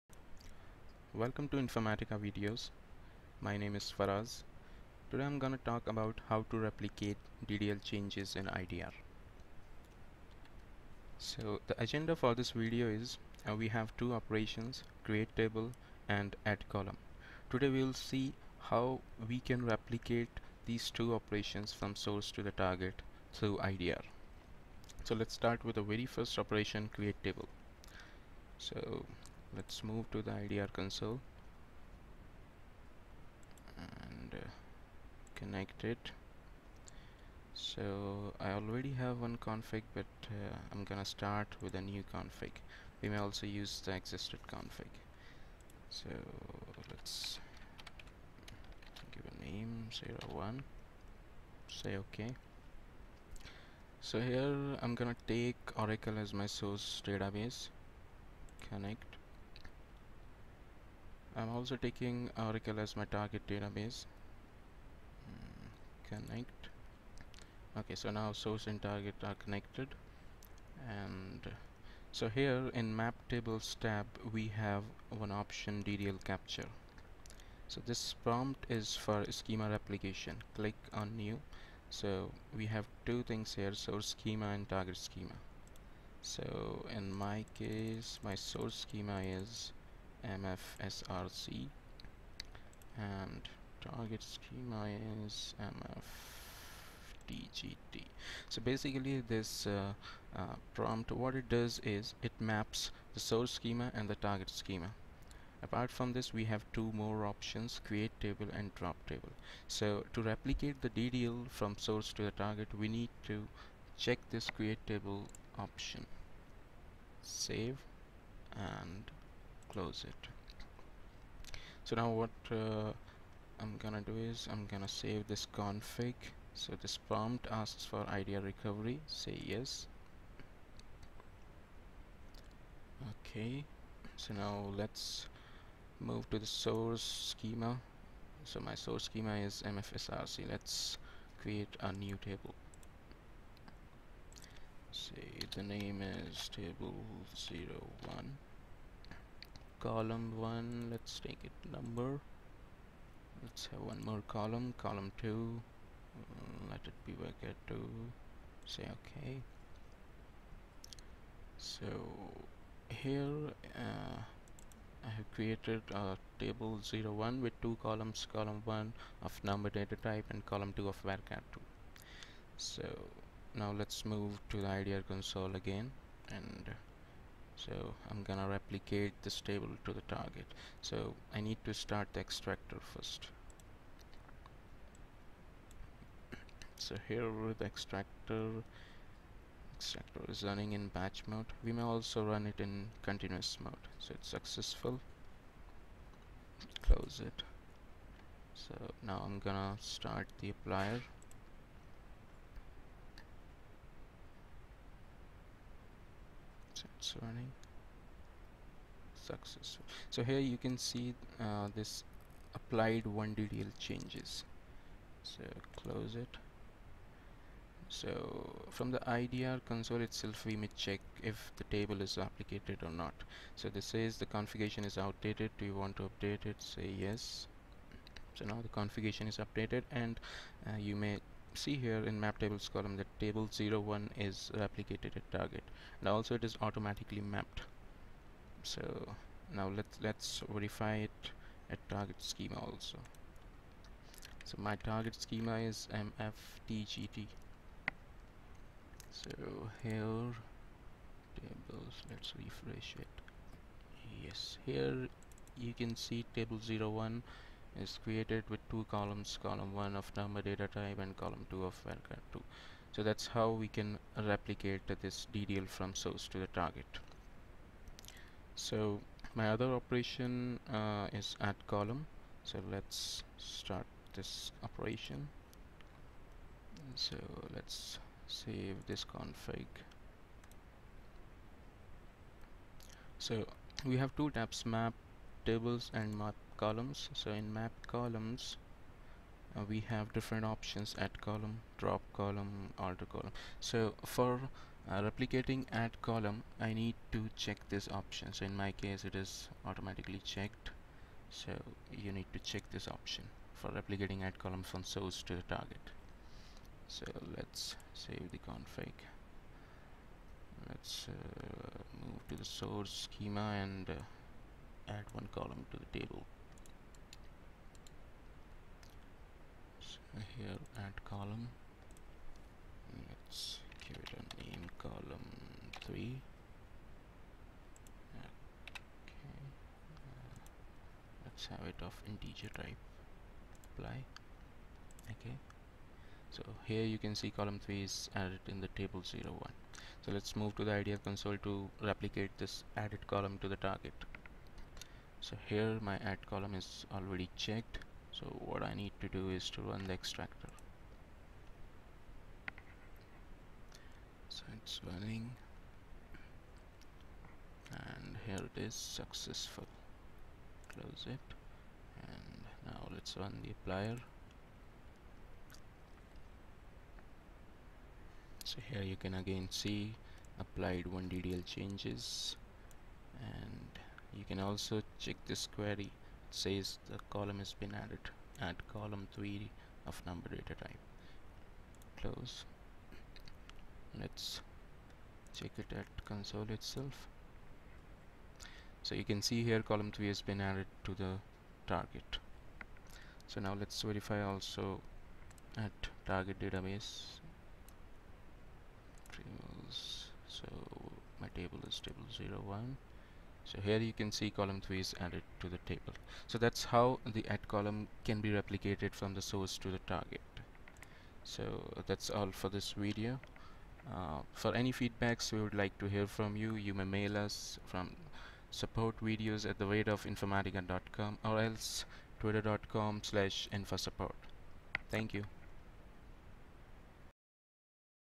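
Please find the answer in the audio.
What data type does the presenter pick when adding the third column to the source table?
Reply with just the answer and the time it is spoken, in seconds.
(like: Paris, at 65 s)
integer, at 332 s.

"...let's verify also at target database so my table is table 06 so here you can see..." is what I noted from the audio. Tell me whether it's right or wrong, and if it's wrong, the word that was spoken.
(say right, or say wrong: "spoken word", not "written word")
wrong: "01", not "06".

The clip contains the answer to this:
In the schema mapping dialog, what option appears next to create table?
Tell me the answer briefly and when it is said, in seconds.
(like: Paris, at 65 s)
drop table, at 108 s.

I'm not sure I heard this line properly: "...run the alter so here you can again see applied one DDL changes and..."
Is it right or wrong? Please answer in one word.
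wrong.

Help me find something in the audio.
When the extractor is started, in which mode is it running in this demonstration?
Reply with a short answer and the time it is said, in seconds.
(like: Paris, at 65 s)
batch mode, at 190 s.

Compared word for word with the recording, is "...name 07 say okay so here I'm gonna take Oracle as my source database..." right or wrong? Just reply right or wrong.
wrong.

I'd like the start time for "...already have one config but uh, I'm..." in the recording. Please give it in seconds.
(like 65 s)
38 s.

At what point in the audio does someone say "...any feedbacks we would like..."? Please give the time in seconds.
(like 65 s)
414 s.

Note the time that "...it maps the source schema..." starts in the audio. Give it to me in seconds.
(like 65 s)
102 s.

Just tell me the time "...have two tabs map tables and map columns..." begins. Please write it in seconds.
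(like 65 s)
283 s.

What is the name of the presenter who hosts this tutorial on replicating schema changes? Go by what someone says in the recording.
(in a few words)
Faraz.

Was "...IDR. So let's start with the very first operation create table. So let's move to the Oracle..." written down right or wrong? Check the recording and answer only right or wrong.
wrong.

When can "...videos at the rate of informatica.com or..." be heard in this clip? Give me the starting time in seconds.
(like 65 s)
418 s.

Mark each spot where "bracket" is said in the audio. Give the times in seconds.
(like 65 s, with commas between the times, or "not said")
157 s.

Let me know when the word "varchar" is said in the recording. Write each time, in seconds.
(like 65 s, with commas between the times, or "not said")
171 s, 261 s.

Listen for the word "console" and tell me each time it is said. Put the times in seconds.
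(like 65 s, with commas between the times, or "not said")
30 s, 175 s, 219 s, 341 s, 386 s.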